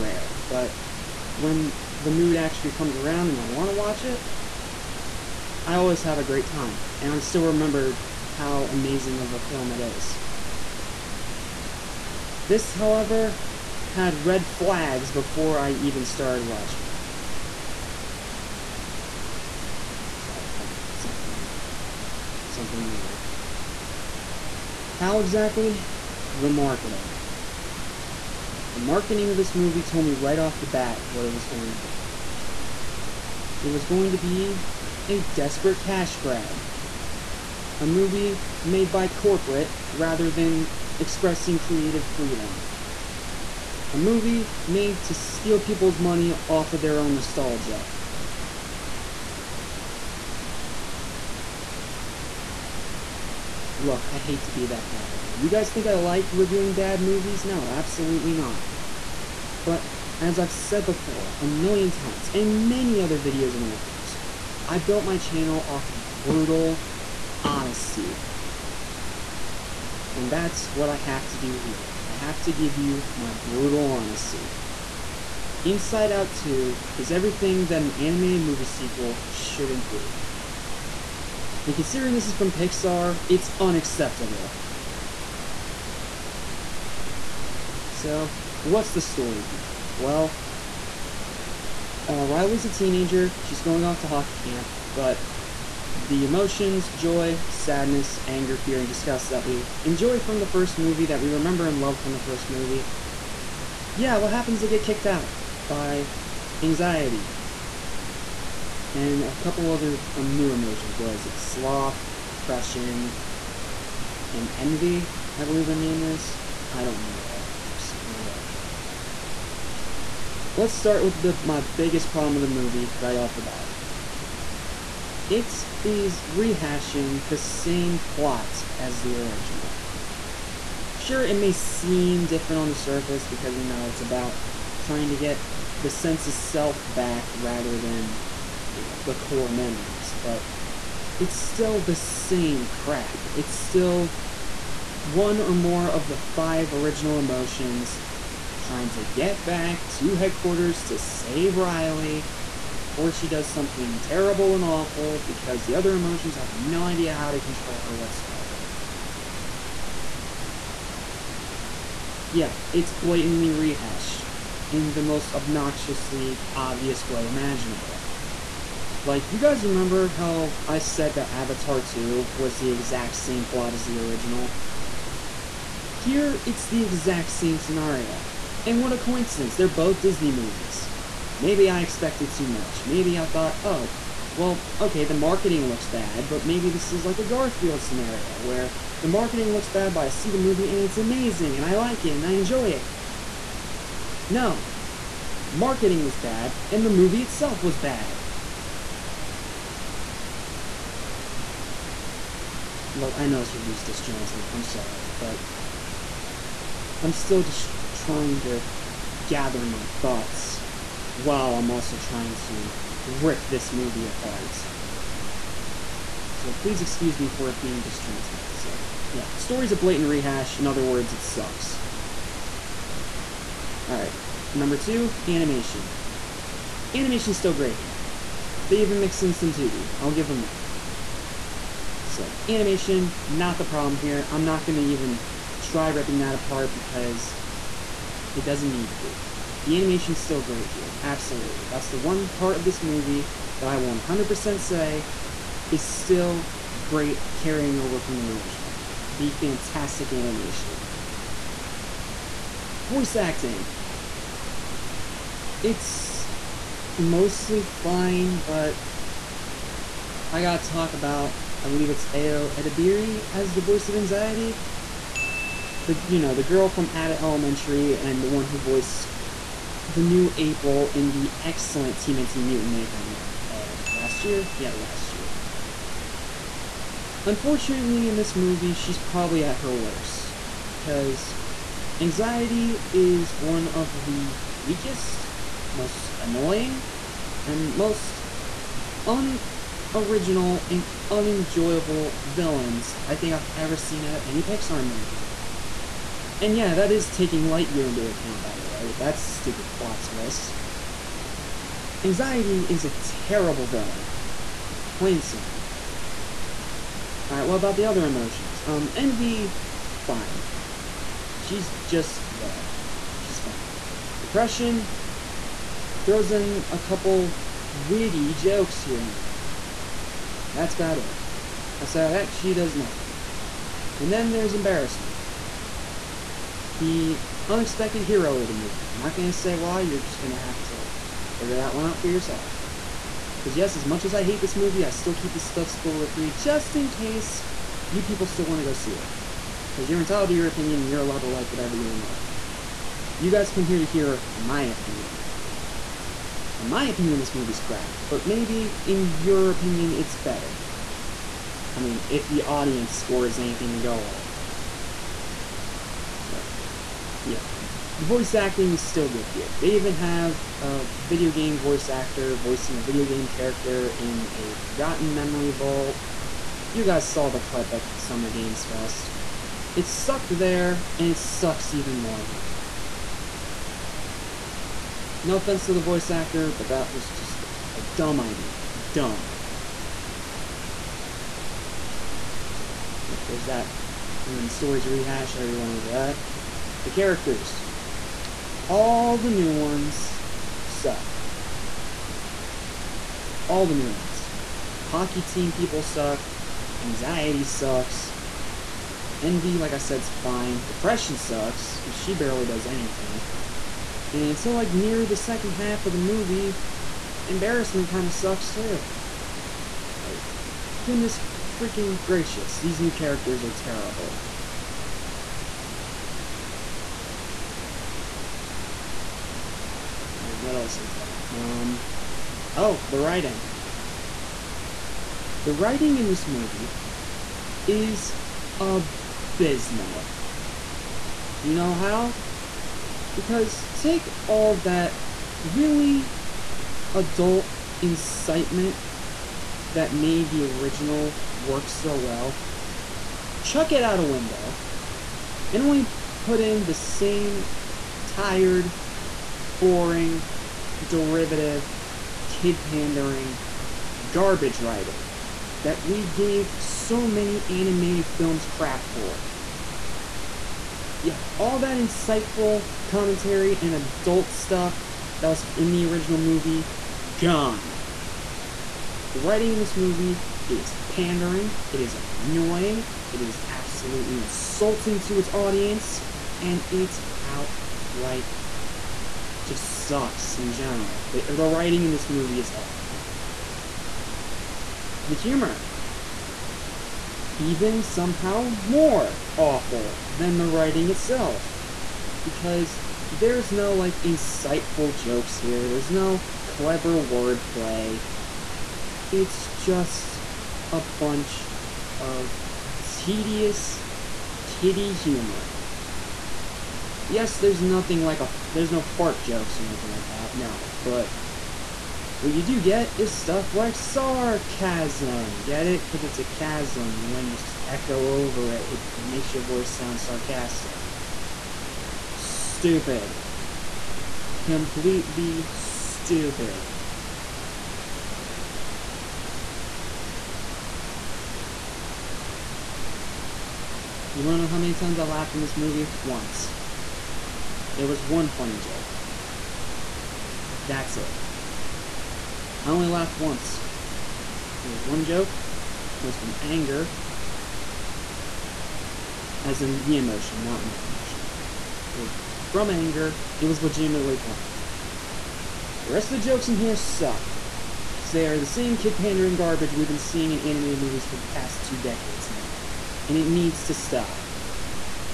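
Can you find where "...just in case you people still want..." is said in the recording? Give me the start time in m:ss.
5:36.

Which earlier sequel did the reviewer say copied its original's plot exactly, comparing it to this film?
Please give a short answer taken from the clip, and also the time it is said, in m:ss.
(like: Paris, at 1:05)
Avatar 2, at 2:51.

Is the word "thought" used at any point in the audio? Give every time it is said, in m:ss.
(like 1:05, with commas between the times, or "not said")
3:03, 3:29.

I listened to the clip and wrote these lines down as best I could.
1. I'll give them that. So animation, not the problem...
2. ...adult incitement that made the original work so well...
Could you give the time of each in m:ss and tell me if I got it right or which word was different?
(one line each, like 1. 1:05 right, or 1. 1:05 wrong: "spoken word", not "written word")
1. 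3:49 right
2. 7:16 right.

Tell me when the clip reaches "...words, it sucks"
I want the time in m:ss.
3:40.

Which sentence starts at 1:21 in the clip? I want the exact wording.
And considering this is from Pixar, it's unacceptable.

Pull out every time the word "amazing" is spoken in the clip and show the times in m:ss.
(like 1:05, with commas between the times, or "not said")
0:08, 3:10.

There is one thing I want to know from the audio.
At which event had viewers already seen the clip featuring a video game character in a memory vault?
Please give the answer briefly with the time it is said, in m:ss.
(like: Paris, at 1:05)
Summer Games Fest, at 6:07.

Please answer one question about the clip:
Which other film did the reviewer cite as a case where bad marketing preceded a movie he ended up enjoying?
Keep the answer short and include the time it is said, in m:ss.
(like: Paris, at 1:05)
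Garfield, at 3:07.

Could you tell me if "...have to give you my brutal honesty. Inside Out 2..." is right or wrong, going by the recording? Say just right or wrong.
right.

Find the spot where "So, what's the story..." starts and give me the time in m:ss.
1:27.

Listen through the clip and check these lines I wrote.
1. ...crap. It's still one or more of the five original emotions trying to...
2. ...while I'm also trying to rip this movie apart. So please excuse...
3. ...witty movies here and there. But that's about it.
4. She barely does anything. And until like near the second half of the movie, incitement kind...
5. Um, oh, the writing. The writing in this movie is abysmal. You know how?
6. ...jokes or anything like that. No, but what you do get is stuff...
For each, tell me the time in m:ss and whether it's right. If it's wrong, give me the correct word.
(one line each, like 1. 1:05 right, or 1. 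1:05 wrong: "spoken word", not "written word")
1. 2:22 right
2. 3:31 right
3. 5:17 wrong: "jokes", not "movies"
4. 6:41 wrong: "embarrassment", not "incitement"
5. 7:01 right
6. 8:29 right.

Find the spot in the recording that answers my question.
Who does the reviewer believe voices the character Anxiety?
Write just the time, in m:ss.
4:22.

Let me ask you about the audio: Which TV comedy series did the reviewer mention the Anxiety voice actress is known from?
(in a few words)
Abbott Elementary.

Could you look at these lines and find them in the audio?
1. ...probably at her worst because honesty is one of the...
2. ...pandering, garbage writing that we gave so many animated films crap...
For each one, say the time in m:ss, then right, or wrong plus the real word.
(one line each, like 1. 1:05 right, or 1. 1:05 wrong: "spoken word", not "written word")
1. 4:38 wrong: "anxiety", not "honesty"
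2. 7:32 right.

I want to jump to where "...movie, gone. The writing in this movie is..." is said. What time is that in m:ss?
7:46.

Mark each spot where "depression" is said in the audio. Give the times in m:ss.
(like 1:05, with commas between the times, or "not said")
1:52, 5:14, 6:40.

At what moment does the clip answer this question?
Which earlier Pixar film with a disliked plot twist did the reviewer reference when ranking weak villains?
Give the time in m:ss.
4:57.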